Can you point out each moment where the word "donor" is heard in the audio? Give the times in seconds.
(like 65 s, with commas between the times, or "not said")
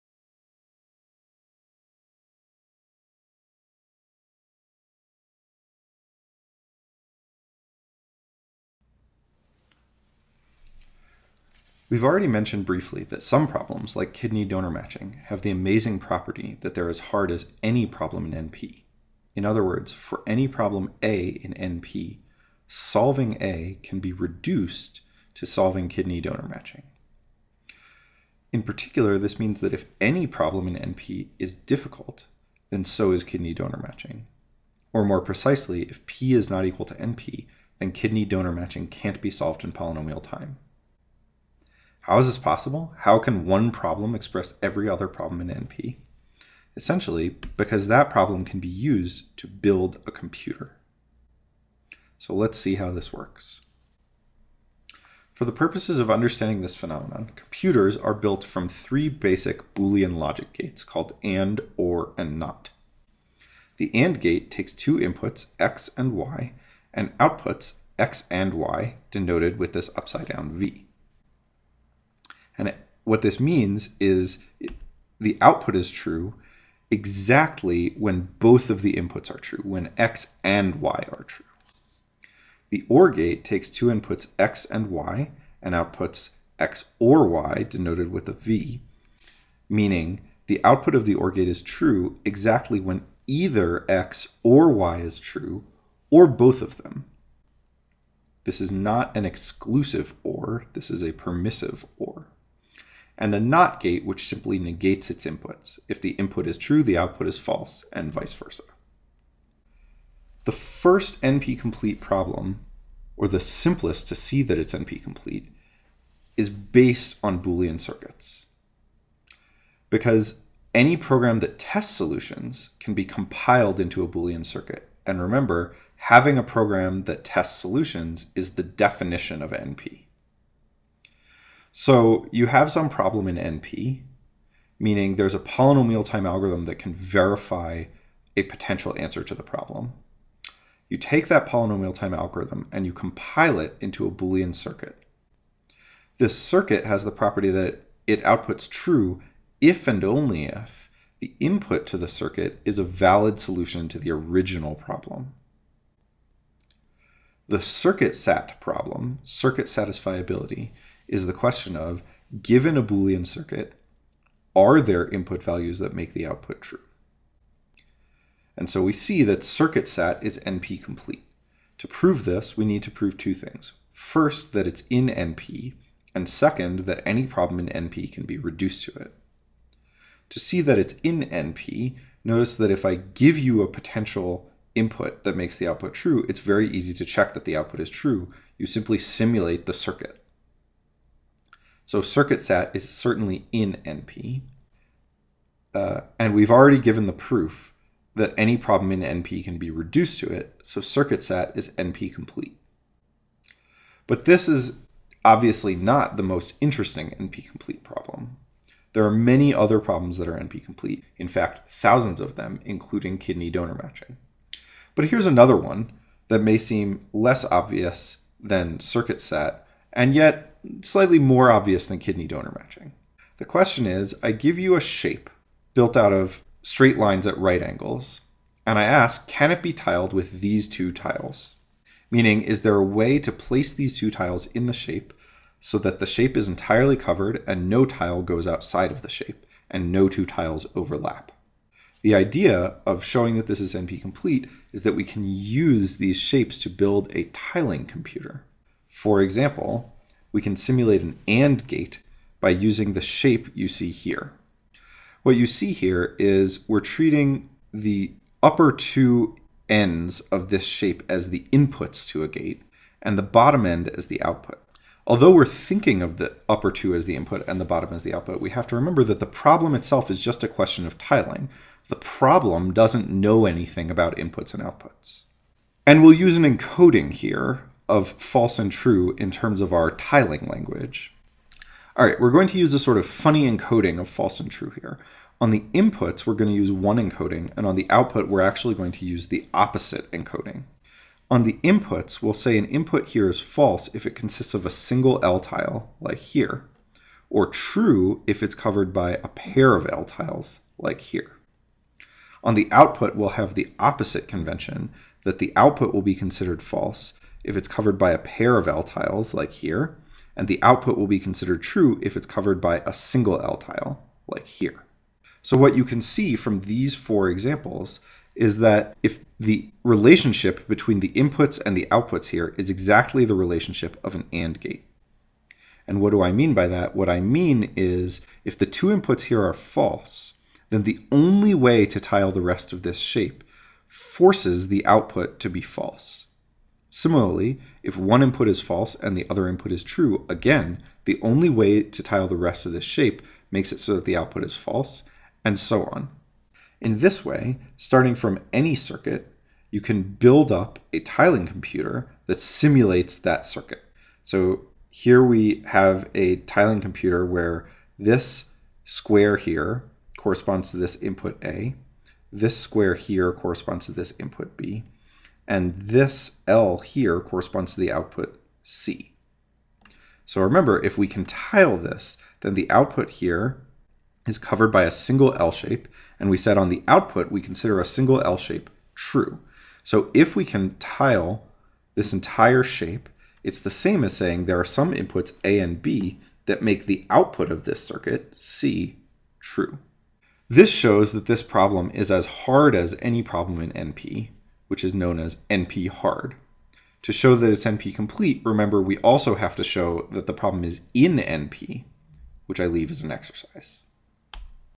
14 s, 26 s, 33 s, 38 s, 213 s, 222 s.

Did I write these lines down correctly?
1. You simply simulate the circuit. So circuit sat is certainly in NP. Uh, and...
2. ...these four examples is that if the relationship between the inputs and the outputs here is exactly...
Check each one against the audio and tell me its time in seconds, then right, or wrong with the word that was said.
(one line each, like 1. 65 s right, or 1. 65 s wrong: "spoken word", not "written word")
1. 188 s right
2. 316 s right.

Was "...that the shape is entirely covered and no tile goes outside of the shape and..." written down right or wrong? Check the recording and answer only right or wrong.
right.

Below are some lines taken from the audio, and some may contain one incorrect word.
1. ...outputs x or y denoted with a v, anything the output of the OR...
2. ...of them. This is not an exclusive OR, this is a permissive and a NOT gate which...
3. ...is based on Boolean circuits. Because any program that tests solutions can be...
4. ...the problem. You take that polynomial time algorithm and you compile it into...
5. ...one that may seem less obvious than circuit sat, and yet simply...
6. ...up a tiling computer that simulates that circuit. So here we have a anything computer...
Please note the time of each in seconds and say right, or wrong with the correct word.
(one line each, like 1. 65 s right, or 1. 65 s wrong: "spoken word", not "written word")
1. 85 s wrong: "meaning", not "anything"
2. 96 s right
3. 116 s right
4. 139 s right
5. 215 s wrong: "slightly", not "simply"
6. 350 s wrong: "tiling", not "anything".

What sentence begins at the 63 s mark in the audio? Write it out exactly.
The AND gate takes two inputs, X and Y, and outputs X and Y, denoted with this upside down V.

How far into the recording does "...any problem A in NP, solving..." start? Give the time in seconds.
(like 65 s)
20 s.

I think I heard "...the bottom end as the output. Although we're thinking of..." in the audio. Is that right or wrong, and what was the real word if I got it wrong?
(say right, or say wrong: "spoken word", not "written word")
right.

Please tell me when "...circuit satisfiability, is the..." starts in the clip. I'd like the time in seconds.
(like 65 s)
159 s.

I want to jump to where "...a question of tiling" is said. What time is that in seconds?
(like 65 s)
270 s.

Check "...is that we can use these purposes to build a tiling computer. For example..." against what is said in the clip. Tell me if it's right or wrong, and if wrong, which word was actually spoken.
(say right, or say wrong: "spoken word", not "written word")
wrong: "shapes", not "purposes".